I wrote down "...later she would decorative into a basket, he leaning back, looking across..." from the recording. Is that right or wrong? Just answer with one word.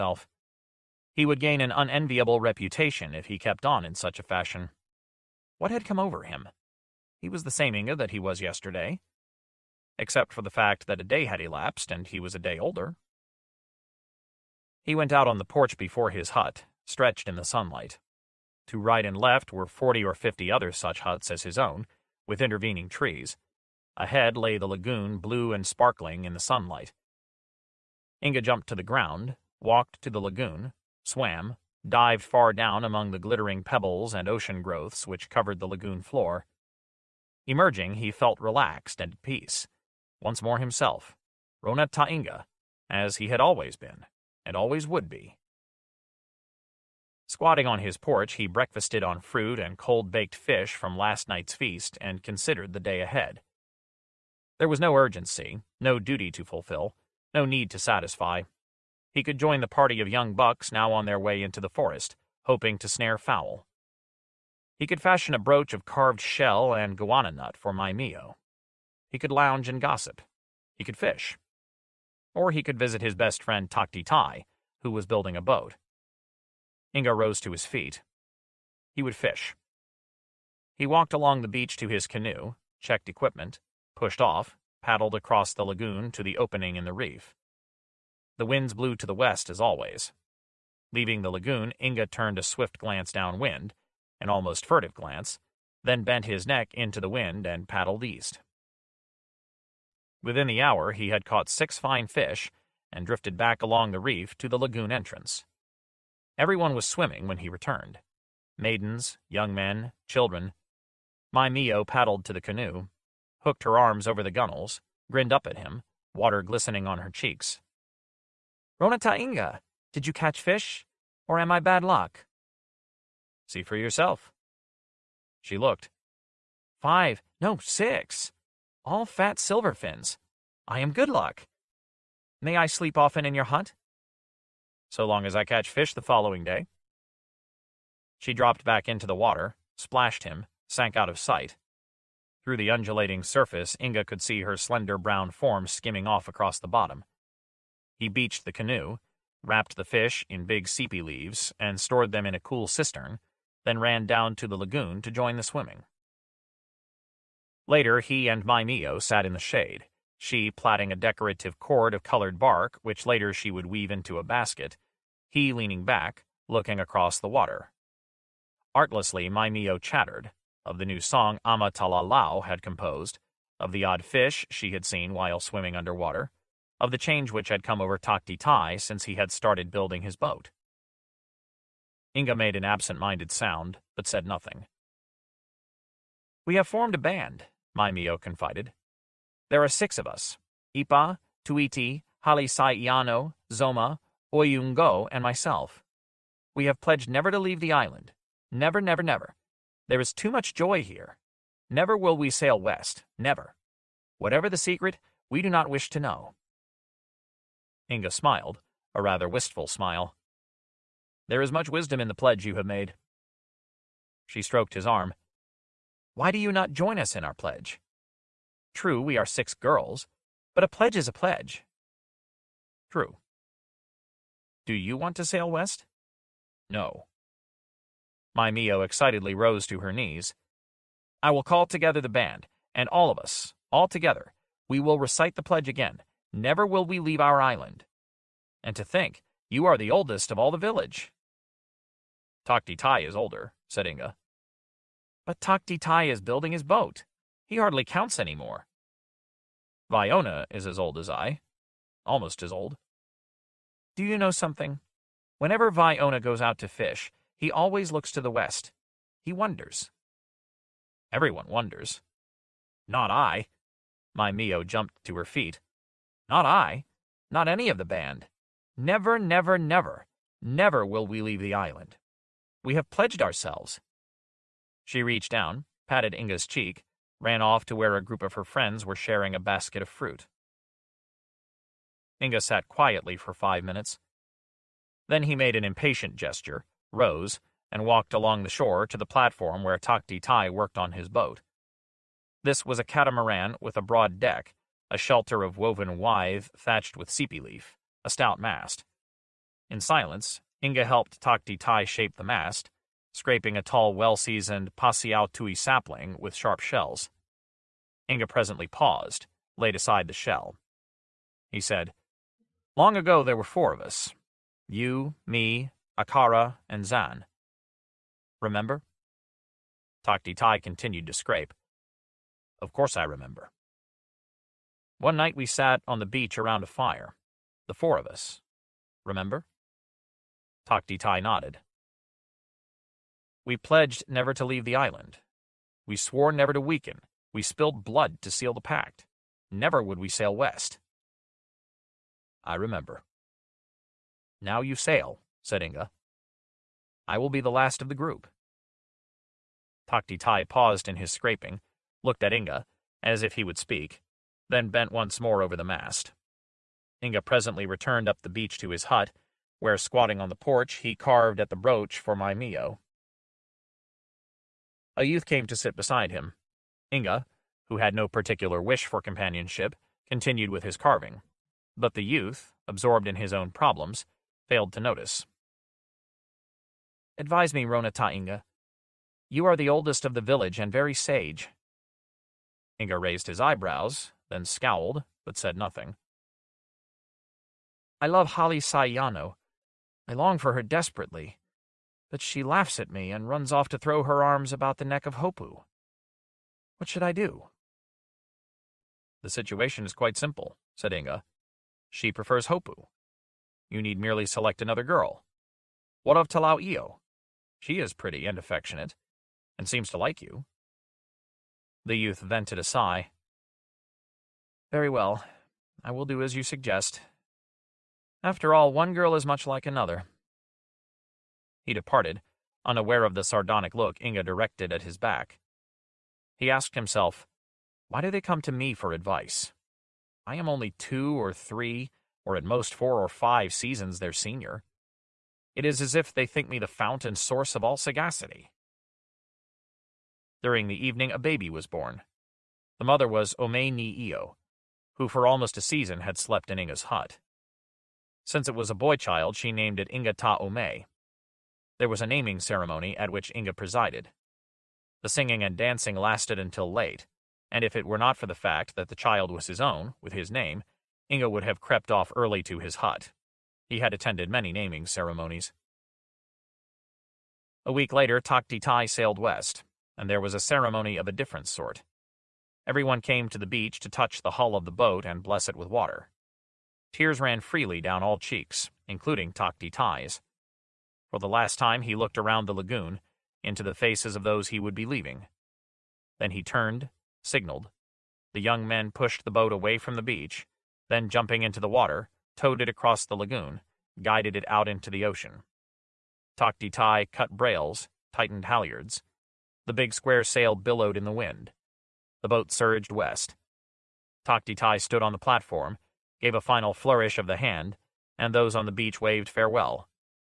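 wrong.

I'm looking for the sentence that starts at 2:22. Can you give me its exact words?
Through the undulating surface, Inga could see her slender brown form skimming off across the bottom.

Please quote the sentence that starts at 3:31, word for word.
There is much wisdom in the pledge you have made.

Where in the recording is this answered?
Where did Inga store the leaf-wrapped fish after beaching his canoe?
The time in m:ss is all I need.
2:32.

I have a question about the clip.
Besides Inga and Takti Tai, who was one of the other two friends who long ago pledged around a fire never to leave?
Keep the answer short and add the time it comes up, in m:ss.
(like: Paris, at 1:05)
Akara, at 5:15.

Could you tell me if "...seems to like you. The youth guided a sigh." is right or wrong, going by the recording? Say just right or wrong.
wrong.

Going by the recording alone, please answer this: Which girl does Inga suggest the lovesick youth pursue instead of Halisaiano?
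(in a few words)
Talao Io.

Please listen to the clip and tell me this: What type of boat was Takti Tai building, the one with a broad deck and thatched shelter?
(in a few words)
A catamaran.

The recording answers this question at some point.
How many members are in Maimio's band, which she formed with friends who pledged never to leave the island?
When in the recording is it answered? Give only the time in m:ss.
3:09.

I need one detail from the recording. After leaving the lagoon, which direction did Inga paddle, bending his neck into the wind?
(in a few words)
East.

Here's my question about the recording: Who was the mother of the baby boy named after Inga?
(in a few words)
Ome Ni Iyo.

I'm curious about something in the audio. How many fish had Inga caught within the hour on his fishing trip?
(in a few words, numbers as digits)
6.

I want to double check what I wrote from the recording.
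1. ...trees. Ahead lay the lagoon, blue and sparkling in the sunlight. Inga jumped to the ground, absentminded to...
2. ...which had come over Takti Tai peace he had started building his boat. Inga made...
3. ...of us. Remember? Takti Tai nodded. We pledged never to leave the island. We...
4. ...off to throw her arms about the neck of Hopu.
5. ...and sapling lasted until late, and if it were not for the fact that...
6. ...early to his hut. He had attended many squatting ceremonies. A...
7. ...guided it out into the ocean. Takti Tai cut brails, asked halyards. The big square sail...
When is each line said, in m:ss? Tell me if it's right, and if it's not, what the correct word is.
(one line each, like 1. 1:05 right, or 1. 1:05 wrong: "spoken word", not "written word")
1. 0:22 wrong: "walked", not "absentminded"
2. 2:57 wrong: "since", not "peace"
3. 5:27 right
4. 6:33 right
5. 7:35 wrong: "dancing", not "sapling"
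6. 7:42 wrong: "naming", not "squatting"
7. 8:14 wrong: "tightened", not "asked".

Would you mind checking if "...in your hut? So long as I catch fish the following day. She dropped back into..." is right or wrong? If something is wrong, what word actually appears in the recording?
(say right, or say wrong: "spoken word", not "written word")
right.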